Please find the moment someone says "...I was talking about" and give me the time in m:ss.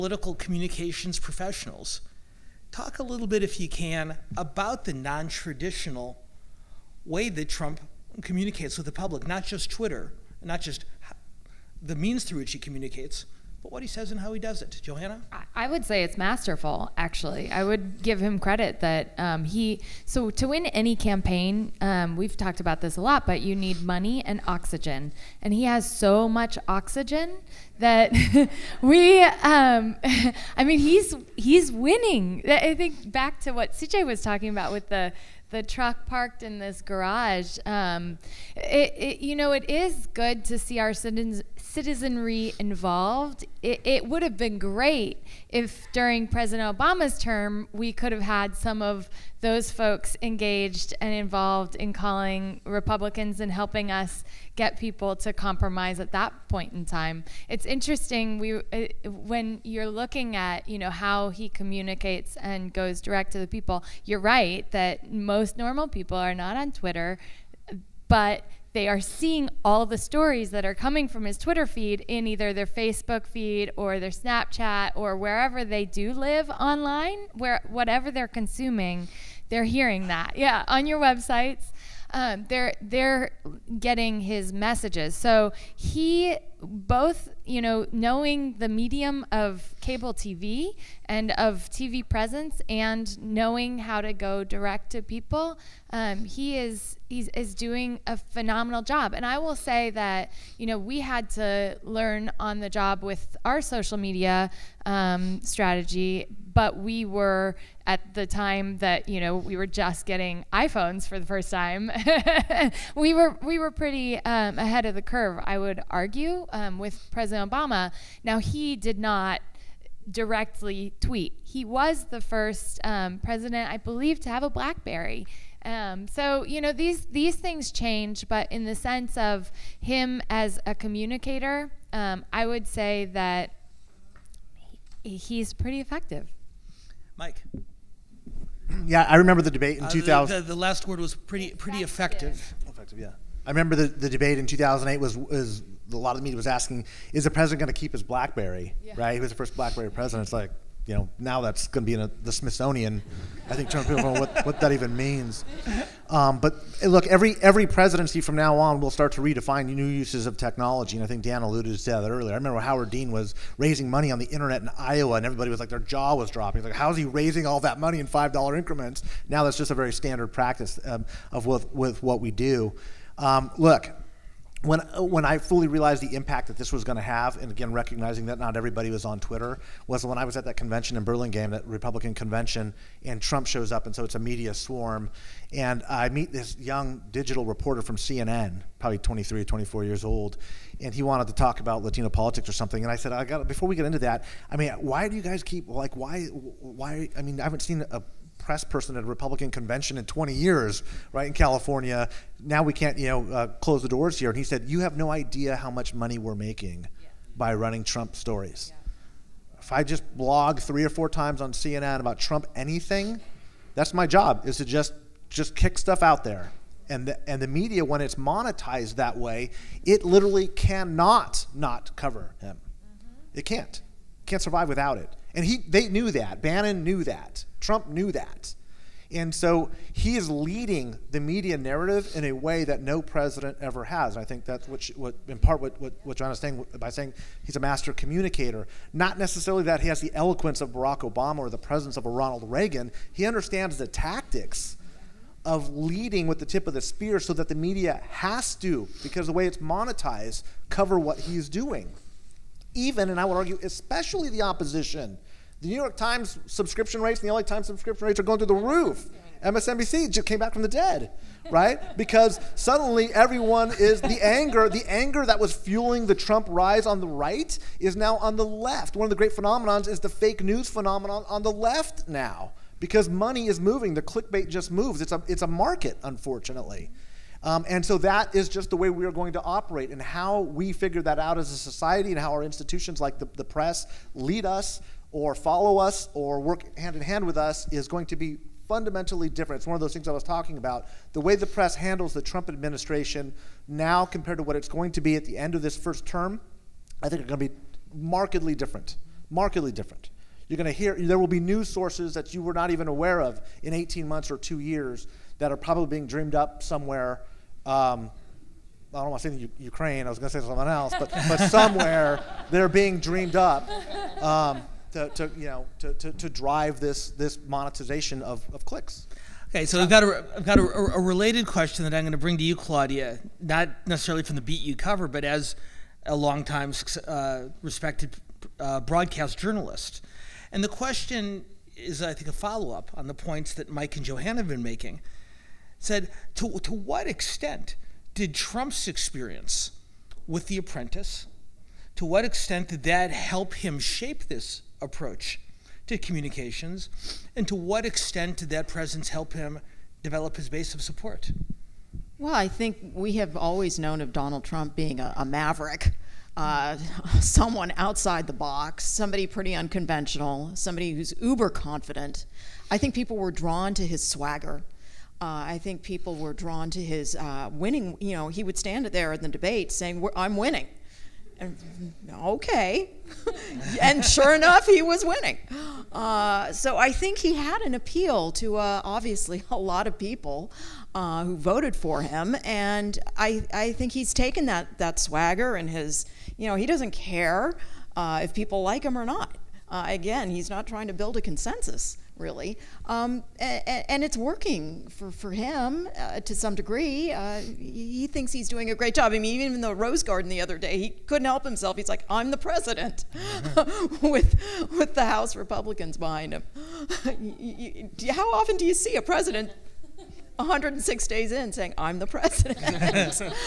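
4:50.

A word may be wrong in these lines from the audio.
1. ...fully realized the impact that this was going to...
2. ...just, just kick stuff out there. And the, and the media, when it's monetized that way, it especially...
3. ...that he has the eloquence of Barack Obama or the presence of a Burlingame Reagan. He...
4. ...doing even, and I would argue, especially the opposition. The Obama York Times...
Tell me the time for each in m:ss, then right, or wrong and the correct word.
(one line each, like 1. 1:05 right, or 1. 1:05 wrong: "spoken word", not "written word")
1. 2:55 right
2. 3:34 wrong: "literally", not "especially"
3. 3:59 wrong: "Ronald", not "Burlingame"
4. 4:11 wrong: "New", not "Obama".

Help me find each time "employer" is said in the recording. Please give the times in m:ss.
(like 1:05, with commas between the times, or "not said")
not said.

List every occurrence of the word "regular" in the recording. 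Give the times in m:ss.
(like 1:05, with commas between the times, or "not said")
not said.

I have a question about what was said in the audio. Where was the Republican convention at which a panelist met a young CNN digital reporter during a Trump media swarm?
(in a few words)
Burlingame.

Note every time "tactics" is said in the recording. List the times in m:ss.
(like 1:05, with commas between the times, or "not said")
4:03.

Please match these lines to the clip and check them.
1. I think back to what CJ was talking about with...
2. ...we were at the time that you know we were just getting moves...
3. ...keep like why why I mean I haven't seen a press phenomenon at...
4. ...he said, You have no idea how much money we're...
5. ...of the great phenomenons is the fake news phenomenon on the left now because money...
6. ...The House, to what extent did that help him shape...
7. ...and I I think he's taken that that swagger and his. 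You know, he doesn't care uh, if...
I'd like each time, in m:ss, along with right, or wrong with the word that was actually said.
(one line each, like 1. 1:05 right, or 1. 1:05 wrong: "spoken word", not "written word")
1. 0:32 right
2. 1:46 wrong: "iPhones", not "moves"
3. 3:15 wrong: "person", not "phenomenon"
4. 3:24 right
5. 4:29 right
6. 5:40 wrong: "Apprentice", not "House"
7. 6:22 right.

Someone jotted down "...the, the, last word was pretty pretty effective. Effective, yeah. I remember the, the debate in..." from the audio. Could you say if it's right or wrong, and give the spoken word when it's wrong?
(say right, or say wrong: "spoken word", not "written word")
right.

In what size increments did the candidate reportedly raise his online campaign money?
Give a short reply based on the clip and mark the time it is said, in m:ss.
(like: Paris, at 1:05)
five dollar, at 2:48.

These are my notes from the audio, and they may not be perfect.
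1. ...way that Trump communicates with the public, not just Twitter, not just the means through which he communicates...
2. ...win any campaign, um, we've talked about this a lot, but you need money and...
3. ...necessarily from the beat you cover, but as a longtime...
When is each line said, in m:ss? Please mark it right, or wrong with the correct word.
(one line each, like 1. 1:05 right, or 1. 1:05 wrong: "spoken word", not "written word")
1. 0:07 right
2. 0:20 right
3. 5:23 right.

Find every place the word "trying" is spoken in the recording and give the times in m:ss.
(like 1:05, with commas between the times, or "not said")
2:33, 6:30.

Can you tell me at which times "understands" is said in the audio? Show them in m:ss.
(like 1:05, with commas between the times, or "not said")
4:03.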